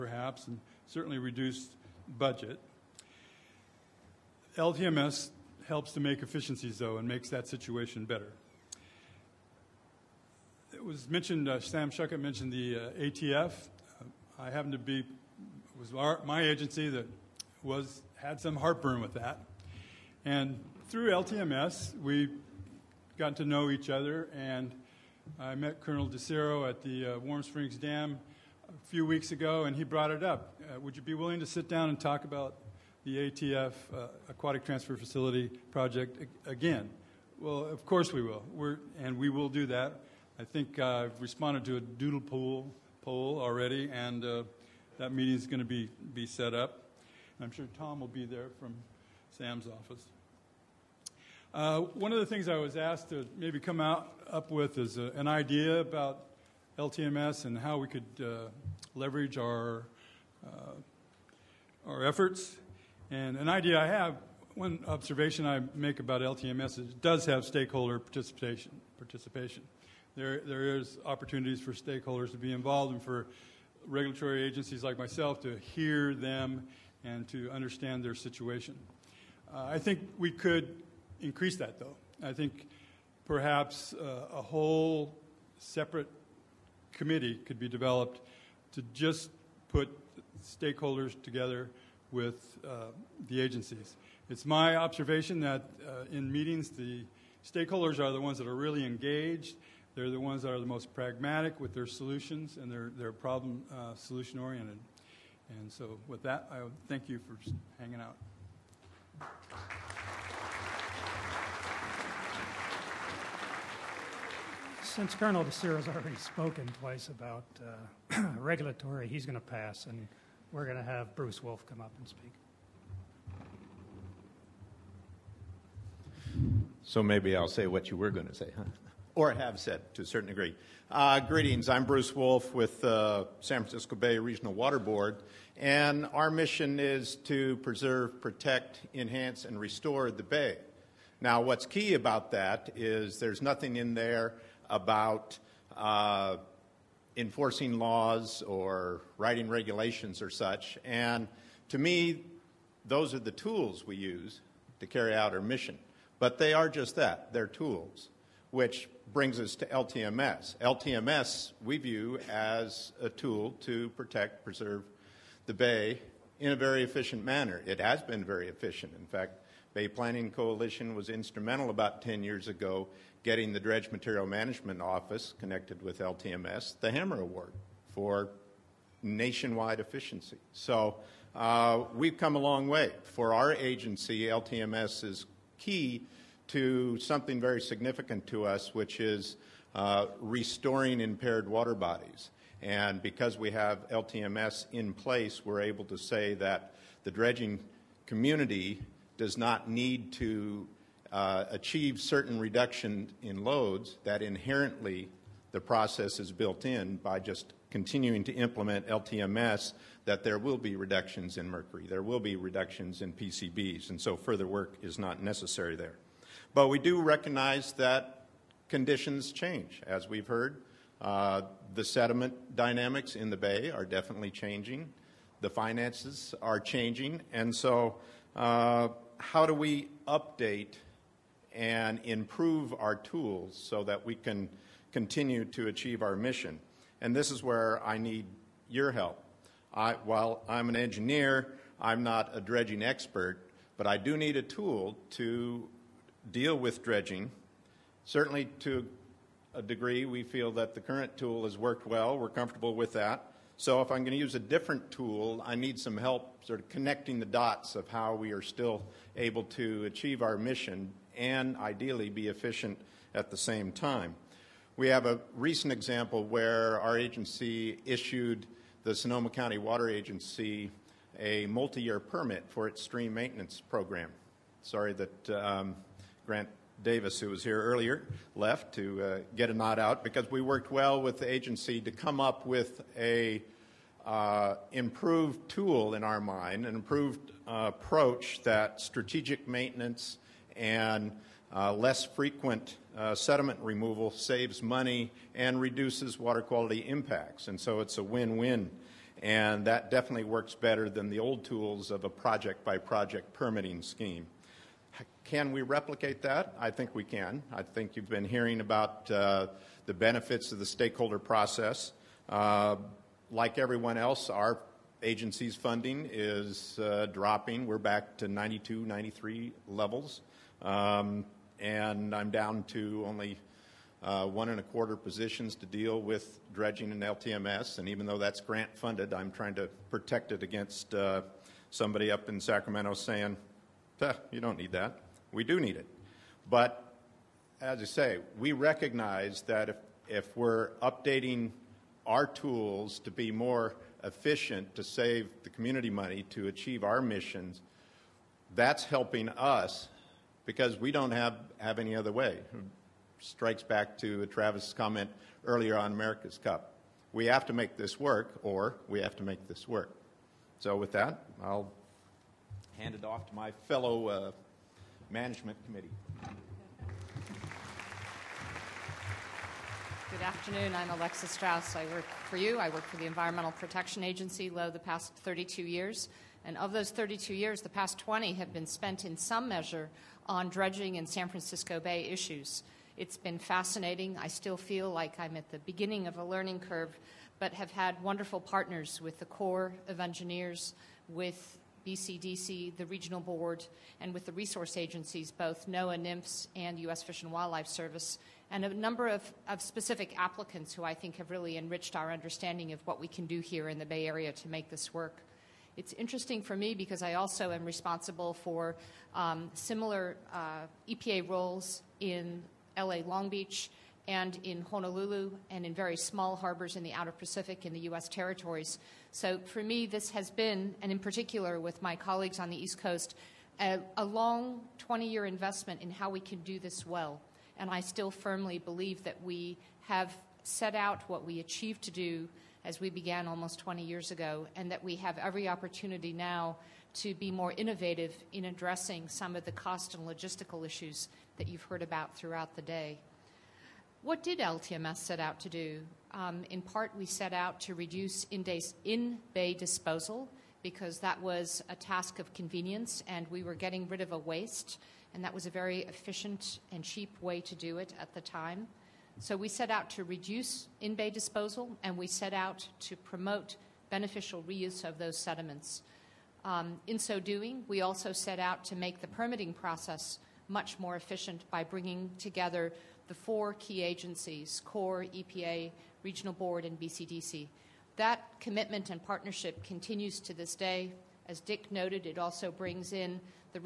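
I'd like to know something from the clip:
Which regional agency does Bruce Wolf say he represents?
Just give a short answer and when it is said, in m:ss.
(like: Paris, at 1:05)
San Francisco Bay Regional Water Board, at 2:13.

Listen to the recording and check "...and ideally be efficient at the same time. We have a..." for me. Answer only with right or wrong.
right.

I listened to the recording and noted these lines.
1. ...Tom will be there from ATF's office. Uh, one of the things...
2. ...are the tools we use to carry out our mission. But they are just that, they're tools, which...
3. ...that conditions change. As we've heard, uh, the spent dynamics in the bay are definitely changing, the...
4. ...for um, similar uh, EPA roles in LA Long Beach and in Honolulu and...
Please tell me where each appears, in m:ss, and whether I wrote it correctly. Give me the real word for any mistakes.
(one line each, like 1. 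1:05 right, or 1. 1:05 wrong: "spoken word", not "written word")
1. 0:47 wrong: "Sam", not "ATF"
2. 2:33 right
3. 3:37 wrong: "sediment", not "spent"
4. 6:48 right.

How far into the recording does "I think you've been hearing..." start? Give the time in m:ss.
5:07.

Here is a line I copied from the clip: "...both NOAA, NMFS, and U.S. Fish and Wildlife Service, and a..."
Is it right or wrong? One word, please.
right.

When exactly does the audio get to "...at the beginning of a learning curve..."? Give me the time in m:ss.
6:25.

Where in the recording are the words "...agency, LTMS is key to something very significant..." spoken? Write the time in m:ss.
3:03.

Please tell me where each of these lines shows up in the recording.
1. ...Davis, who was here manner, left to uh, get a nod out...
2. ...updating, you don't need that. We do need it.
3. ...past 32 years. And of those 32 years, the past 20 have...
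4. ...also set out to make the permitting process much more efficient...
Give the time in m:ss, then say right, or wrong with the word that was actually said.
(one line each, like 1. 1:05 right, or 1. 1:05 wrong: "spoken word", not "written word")
1. 4:36 wrong: "earlier", not "manner"
2. 5:32 wrong: "saying", not "updating"
3. 6:14 right
4. 7:47 right.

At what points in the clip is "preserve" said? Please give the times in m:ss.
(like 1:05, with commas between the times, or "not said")
2:17, 2:44.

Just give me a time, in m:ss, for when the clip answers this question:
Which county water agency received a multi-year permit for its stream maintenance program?
4:28.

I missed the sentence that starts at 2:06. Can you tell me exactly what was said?
So maybe I'll say what you were going to say, huh?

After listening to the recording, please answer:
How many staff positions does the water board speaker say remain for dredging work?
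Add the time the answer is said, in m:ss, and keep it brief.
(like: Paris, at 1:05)
1.25, at 5:24.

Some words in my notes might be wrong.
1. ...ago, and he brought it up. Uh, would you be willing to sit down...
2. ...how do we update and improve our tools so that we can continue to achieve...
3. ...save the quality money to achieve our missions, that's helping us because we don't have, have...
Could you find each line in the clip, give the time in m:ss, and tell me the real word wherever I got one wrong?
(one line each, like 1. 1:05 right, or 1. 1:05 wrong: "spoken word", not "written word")
1. 0:29 right
2. 3:49 right
3. 5:44 wrong: "community", not "quality".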